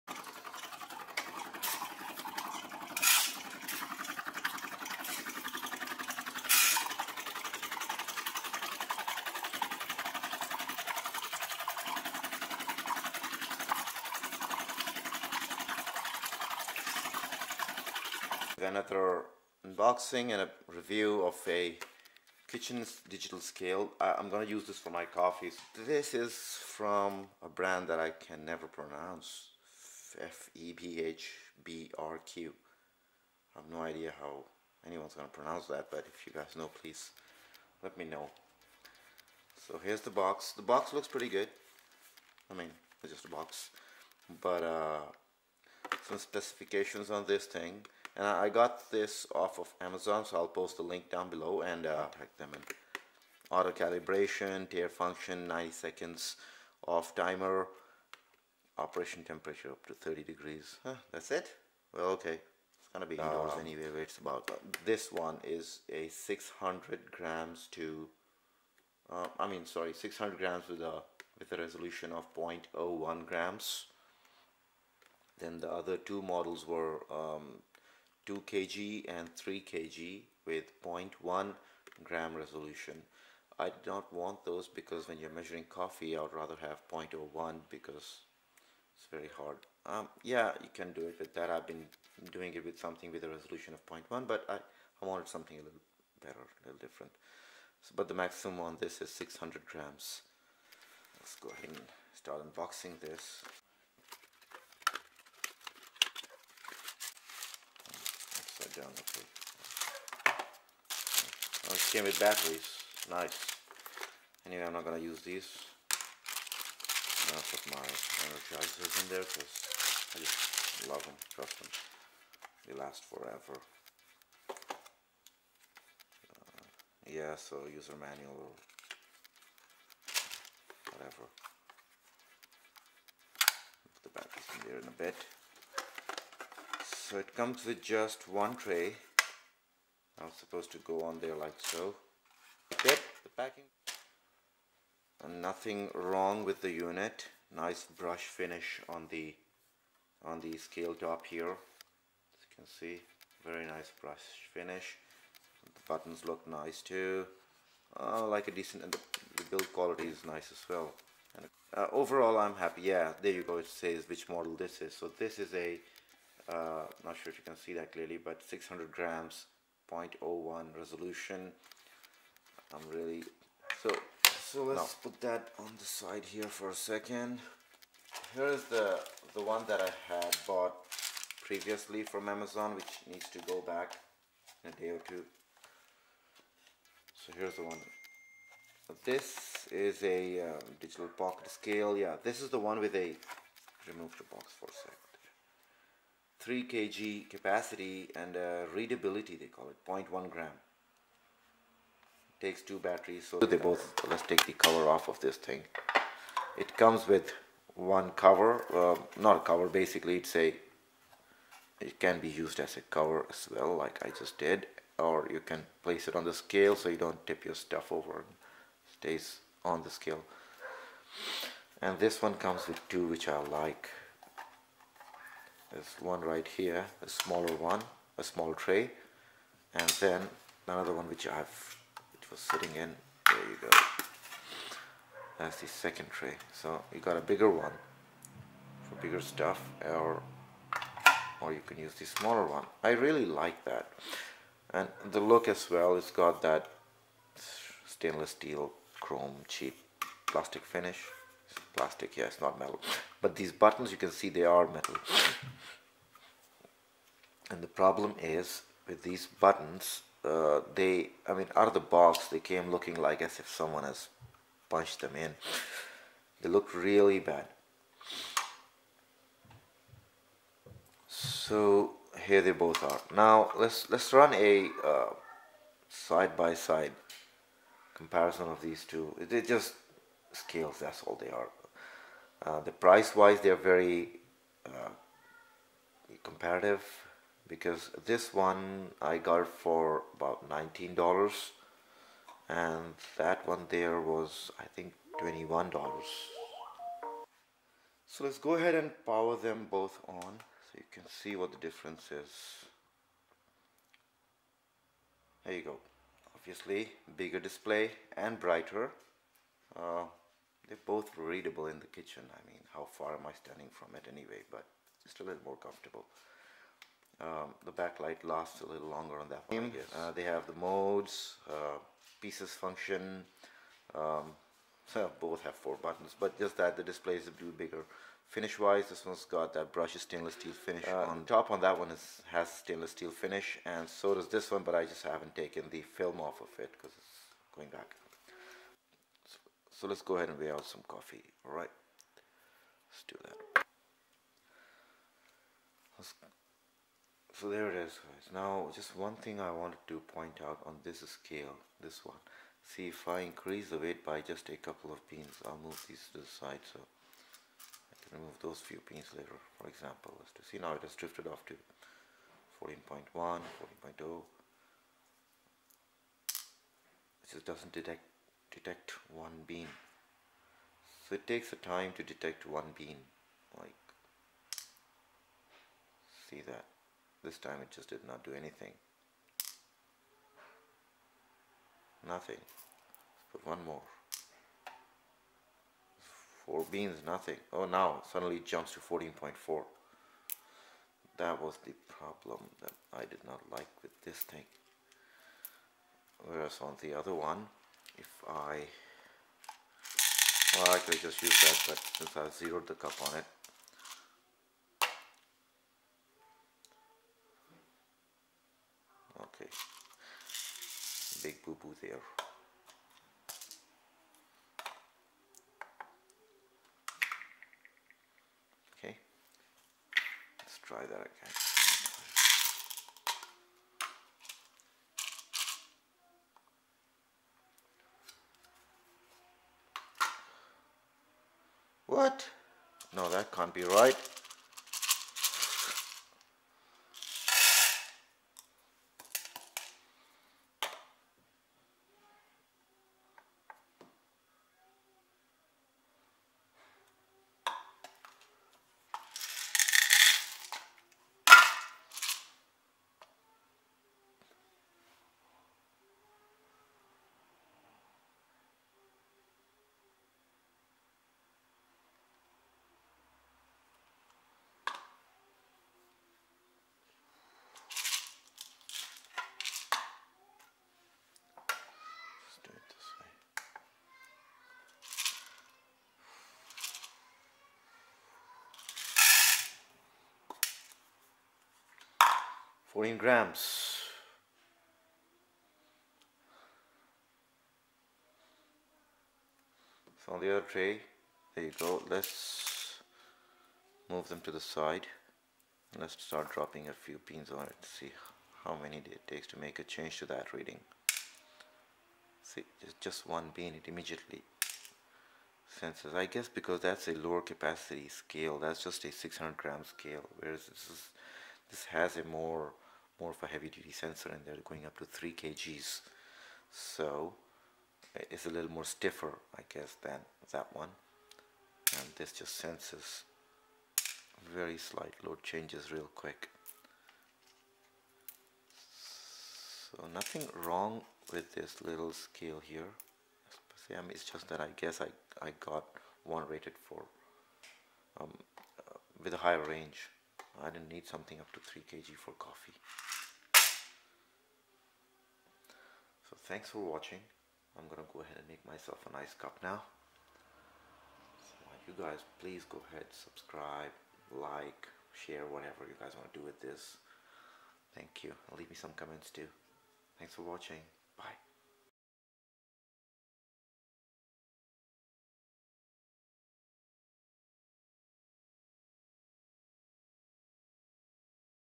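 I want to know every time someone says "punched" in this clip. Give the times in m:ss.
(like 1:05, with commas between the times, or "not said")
4:24.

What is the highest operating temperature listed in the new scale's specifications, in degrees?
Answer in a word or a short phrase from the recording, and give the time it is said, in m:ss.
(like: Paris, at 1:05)
30 degrees, at 0:59.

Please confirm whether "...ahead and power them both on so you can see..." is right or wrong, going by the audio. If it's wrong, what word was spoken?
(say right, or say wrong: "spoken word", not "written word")
right.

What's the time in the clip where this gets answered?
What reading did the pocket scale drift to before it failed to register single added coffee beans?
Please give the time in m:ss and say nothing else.
6:02.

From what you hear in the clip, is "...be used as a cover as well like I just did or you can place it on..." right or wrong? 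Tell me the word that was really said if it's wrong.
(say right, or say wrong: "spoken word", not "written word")
right.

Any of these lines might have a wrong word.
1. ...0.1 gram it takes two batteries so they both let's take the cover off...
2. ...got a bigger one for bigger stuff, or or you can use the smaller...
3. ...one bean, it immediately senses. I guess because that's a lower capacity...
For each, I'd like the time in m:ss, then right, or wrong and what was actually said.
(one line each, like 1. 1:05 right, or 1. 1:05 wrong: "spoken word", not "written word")
1. 3:19 right
2. 3:56 right
3. 8:23 right.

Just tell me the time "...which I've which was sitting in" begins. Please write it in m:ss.
3:51.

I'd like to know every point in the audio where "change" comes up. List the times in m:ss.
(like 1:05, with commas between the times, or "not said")
8:19, 8:45.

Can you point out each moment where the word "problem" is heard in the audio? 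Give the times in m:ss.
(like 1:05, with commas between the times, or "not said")
4:17, 6:31.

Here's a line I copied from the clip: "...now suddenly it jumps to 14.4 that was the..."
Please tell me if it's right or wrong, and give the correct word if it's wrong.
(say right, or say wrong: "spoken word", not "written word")
right.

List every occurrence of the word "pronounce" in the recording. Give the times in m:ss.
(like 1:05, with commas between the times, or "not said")
0:28, 0:35.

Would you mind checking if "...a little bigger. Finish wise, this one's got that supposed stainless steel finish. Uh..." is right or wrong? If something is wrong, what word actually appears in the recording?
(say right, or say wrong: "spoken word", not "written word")
wrong: "brushed", not "supposed".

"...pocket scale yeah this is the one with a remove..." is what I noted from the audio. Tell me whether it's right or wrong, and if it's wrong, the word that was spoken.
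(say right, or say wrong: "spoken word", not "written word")
right.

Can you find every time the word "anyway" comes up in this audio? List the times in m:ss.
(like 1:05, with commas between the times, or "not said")
1:03, 1:54, 5:14.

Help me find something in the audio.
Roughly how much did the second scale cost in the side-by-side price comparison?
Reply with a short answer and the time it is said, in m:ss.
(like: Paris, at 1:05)
$21, at 4:55.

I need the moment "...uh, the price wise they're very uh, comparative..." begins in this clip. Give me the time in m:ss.
4:42.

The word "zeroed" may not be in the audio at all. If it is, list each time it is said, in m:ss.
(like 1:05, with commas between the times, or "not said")
6:42.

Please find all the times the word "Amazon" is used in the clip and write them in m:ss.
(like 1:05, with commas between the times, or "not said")
0:49, 3:02.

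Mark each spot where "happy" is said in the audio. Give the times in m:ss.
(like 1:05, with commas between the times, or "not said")
2:42.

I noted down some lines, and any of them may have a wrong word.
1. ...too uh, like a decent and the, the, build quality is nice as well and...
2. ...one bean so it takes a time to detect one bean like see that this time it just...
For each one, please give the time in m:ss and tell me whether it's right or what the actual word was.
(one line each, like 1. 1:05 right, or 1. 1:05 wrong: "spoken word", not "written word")
1. 2:36 right
2. 6:09 right.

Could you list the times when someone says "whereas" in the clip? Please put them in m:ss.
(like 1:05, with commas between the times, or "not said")
6:36, 8:30.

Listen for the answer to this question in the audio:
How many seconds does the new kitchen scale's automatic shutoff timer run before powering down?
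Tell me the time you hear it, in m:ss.
0:55.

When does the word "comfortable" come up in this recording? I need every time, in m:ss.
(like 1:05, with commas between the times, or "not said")
5:15.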